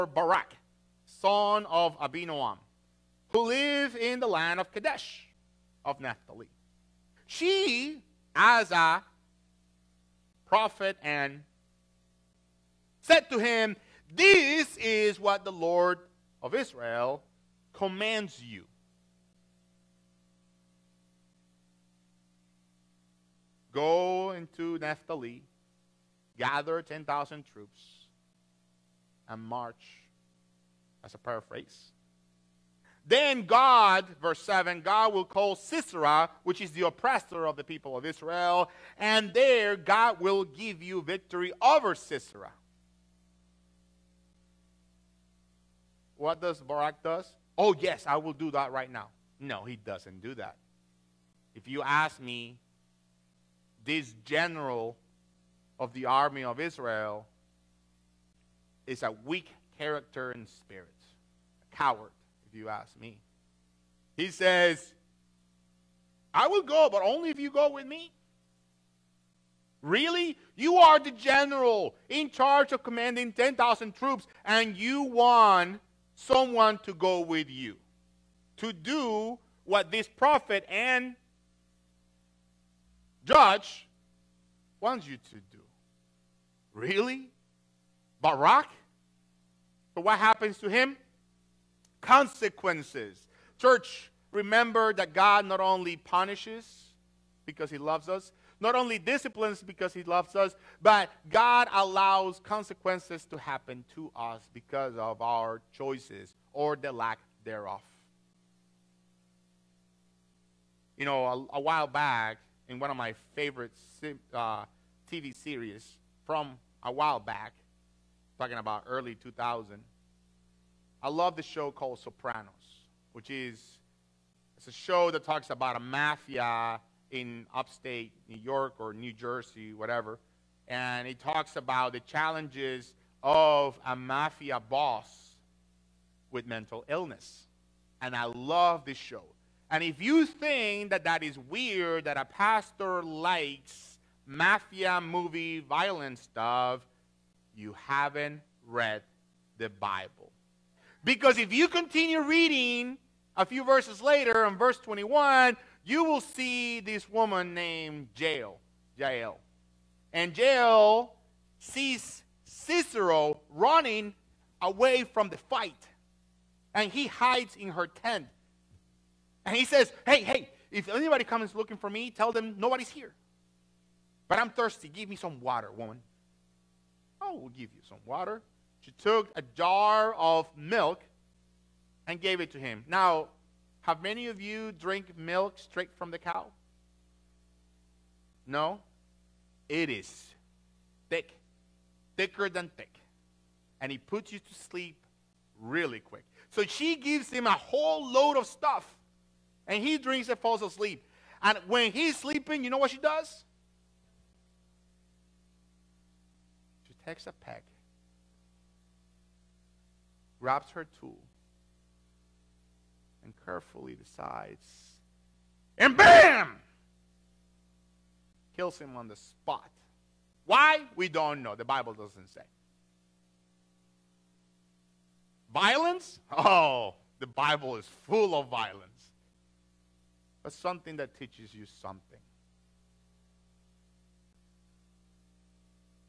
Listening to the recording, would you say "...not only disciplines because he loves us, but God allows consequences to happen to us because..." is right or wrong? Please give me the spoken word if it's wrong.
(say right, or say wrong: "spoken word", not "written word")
right.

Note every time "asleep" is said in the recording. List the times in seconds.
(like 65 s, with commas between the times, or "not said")
200 s.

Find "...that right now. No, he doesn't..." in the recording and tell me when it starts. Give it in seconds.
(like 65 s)
48 s.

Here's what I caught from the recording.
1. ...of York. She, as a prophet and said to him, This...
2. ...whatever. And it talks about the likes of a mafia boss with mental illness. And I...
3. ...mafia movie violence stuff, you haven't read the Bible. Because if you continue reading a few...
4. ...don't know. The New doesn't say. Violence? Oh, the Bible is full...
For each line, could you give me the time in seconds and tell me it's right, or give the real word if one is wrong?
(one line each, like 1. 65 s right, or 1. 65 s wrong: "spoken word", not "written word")
1. 5 s wrong: "Naphtali", not "York"
2. 129 s wrong: "challenges", not "likes"
3. 144 s right
4. 221 s wrong: "Bible", not "New".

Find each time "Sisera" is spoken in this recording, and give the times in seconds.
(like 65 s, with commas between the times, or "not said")
35 s, 41 s, 162 s.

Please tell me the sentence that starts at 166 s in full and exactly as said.
And he hides in her tent.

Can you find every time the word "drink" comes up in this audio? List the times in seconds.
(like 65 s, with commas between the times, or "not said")
184 s, 199 s.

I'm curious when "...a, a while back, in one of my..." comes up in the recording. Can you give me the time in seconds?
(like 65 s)
111 s.